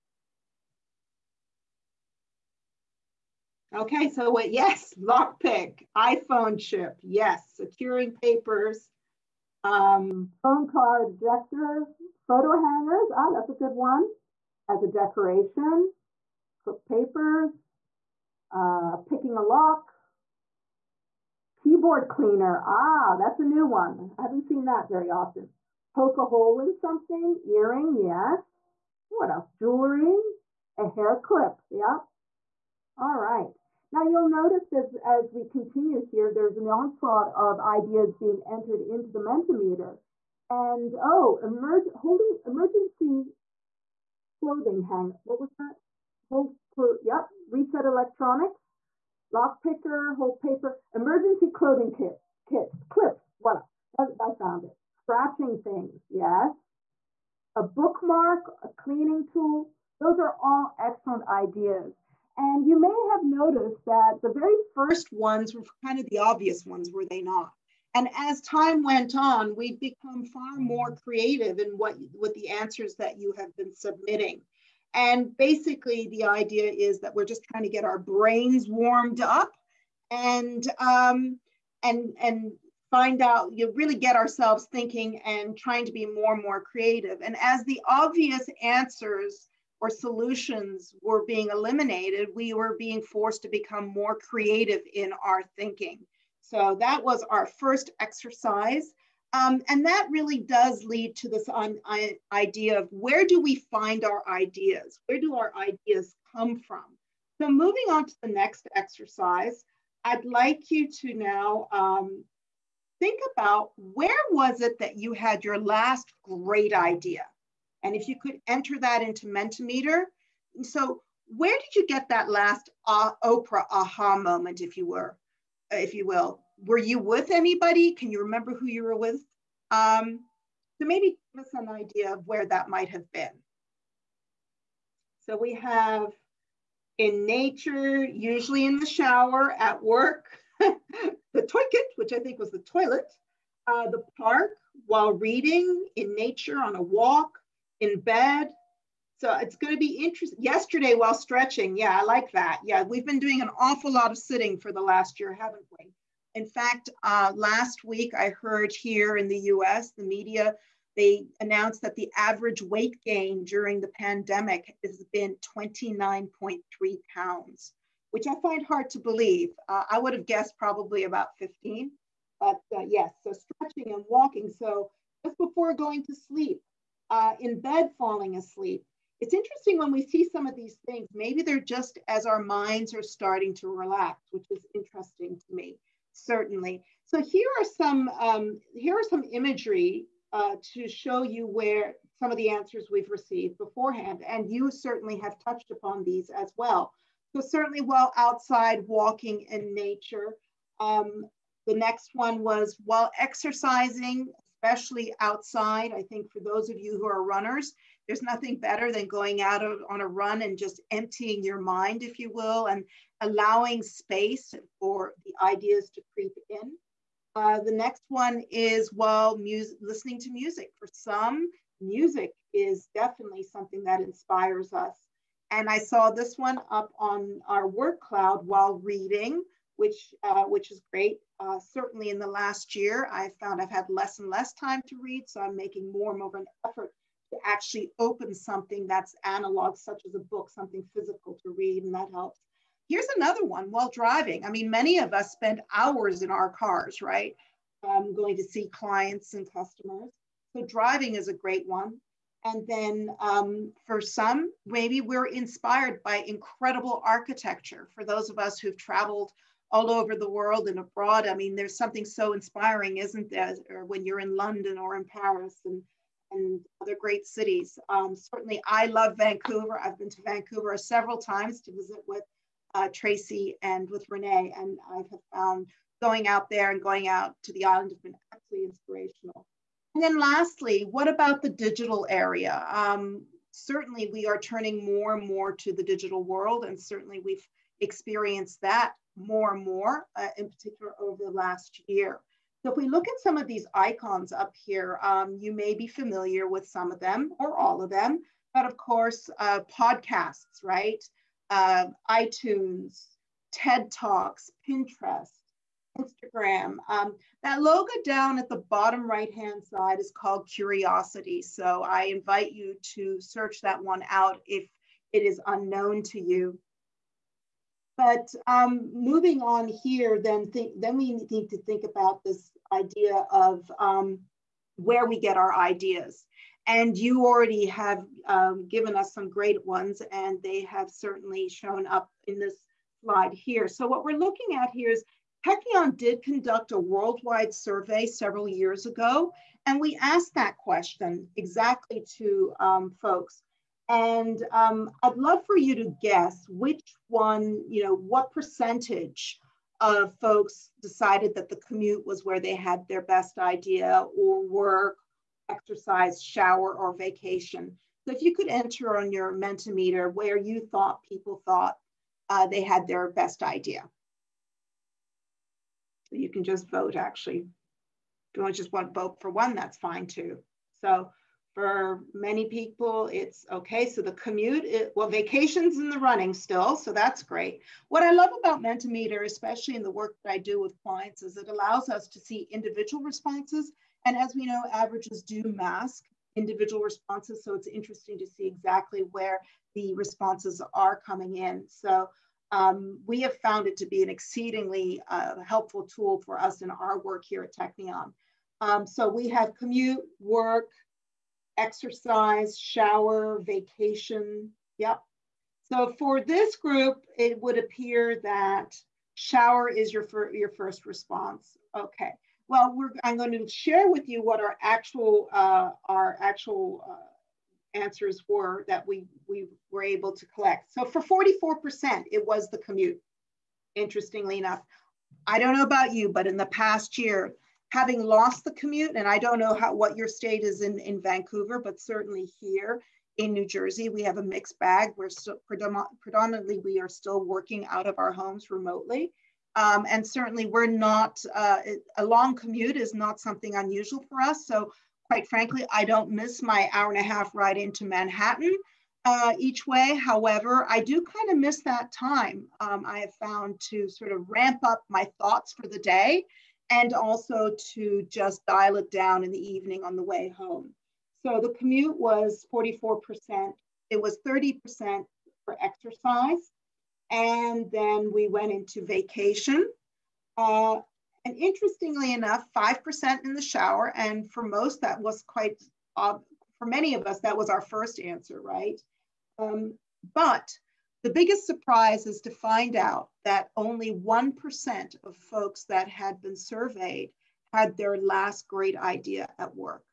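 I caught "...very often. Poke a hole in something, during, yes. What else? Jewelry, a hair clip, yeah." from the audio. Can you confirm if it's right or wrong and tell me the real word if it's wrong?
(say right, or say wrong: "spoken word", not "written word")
wrong: "earring", not "during".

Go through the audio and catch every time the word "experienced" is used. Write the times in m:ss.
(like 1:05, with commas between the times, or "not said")
4:47.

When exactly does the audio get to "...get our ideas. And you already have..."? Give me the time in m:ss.
5:25.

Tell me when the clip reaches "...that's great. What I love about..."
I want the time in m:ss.
6:16.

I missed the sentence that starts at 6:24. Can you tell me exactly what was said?
And as we know, averages do mask individual responses.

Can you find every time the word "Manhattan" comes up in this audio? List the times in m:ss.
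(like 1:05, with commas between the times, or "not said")
7:27.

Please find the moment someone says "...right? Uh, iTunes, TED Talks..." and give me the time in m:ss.
5:00.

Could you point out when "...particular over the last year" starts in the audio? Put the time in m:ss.
4:50.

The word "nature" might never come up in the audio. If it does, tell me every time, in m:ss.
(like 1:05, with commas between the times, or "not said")
2:17, 2:26, 3:19.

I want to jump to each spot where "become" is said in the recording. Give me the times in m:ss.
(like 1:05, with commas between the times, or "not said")
1:09, 1:33.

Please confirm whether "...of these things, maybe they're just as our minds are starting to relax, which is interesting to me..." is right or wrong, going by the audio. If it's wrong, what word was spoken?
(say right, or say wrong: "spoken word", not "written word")
right.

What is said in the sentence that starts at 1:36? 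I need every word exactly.
So that was our first exercise.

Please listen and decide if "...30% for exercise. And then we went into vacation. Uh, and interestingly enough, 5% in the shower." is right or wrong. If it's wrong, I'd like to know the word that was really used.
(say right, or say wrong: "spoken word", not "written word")
right.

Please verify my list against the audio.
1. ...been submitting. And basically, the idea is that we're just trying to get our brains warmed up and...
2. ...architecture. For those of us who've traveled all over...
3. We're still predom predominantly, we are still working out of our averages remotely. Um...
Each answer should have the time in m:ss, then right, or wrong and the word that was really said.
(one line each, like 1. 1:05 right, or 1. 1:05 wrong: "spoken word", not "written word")
1. 1:13 right
2. 4:17 right
3. 7:14 wrong: "homes", not "averages".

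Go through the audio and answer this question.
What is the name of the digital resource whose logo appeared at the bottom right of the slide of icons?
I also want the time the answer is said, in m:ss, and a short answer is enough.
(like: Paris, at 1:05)
Curiosity, at 5:10.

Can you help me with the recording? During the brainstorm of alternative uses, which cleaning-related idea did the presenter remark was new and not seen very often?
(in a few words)
Keyboard cleaner.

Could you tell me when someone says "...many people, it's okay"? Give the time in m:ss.
6:12.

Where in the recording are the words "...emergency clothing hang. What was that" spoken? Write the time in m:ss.
0:42.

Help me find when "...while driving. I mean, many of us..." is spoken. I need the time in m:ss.
4:03.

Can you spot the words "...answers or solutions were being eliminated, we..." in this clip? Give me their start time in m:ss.
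1:28.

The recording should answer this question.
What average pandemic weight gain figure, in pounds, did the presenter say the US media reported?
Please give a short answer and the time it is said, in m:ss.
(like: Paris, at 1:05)
29.3, at 2:45.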